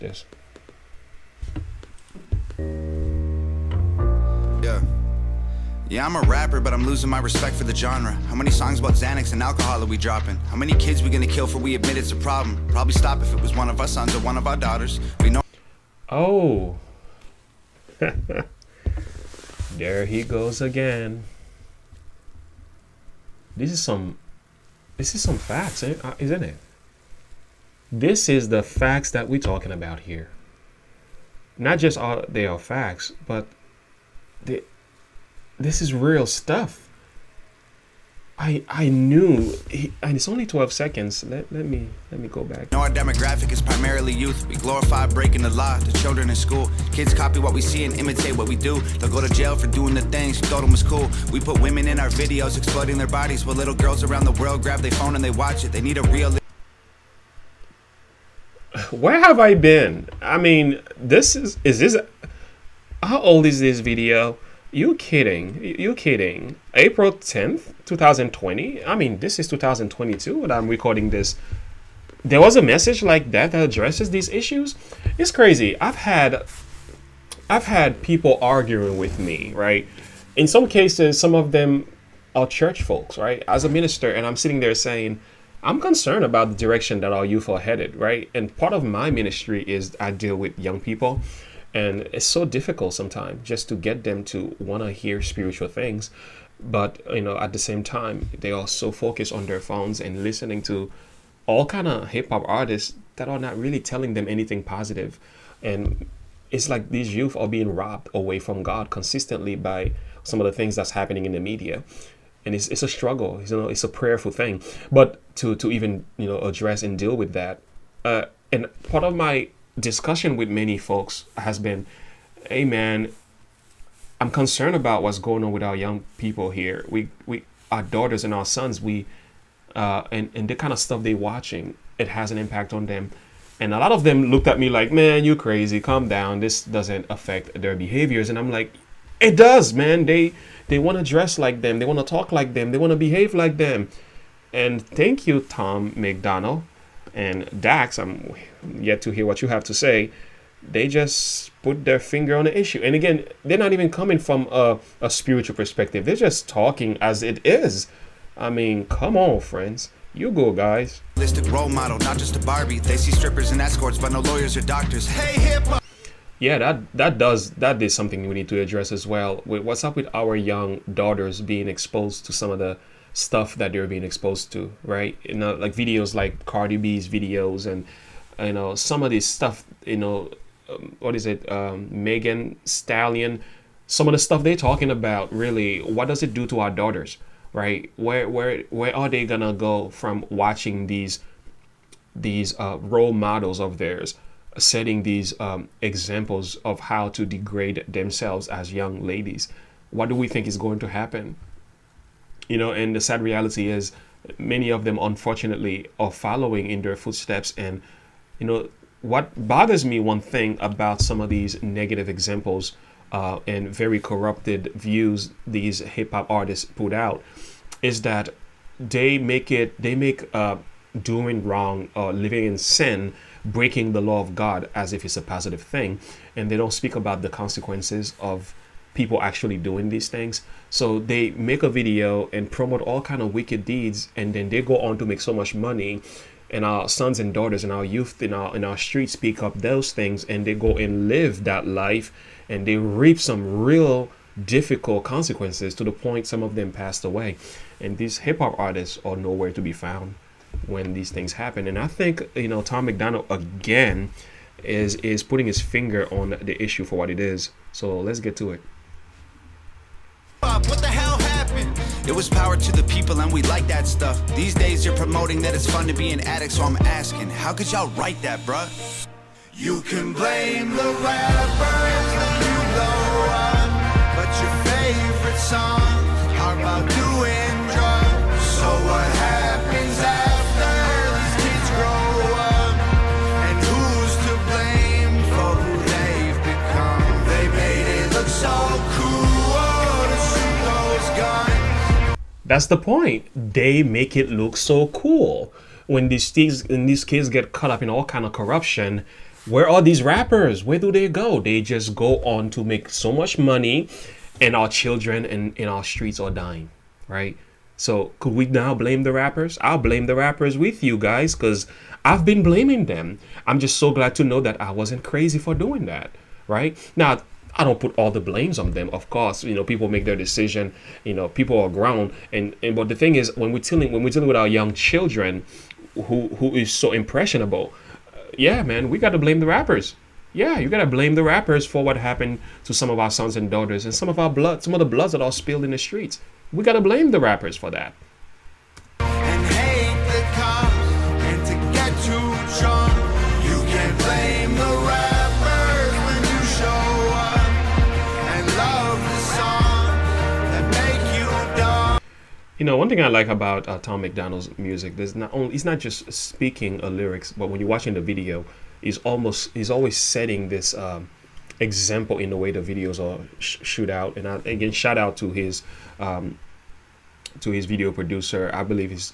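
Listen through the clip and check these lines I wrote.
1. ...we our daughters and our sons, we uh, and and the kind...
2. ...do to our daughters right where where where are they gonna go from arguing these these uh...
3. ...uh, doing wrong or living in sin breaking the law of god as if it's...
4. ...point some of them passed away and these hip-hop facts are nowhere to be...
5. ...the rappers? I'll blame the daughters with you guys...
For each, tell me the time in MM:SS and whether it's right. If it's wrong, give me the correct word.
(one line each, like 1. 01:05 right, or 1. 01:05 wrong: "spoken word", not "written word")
1. 02:07 right
2. 03:06 wrong: "watching", not "arguing"
3. 03:40 right
4. 04:05 wrong: "artists", not "facts"
5. 05:09 wrong: "rappers", not "daughters".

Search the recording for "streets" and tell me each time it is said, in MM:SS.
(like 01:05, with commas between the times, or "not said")
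03:58, 05:05, 05:35.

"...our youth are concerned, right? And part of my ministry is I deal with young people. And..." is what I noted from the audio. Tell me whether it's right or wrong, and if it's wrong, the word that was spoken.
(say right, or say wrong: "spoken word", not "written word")
wrong: "headed", not "concerned".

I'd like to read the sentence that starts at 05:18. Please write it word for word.
Of course, you know, people make their decision.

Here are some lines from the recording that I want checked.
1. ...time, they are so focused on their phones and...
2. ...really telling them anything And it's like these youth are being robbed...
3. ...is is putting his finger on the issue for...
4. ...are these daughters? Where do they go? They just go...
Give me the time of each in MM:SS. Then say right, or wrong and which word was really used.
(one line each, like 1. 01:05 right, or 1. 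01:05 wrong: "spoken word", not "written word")
1. 01:37 right
2. 01:43 right
3. 04:14 right
4. 04:59 wrong: "rappers", not "daughters".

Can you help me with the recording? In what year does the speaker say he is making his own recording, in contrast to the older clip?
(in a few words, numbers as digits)
2022.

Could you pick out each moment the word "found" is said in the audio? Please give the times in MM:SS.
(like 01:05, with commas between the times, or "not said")
04:09.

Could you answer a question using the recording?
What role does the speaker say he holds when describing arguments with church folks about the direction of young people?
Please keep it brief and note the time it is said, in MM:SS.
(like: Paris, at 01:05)
minister, at 01:23.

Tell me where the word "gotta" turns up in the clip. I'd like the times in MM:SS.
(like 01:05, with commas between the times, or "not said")
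05:30, 05:36.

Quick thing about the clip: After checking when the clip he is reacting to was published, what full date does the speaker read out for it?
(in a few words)
April 10, 2020.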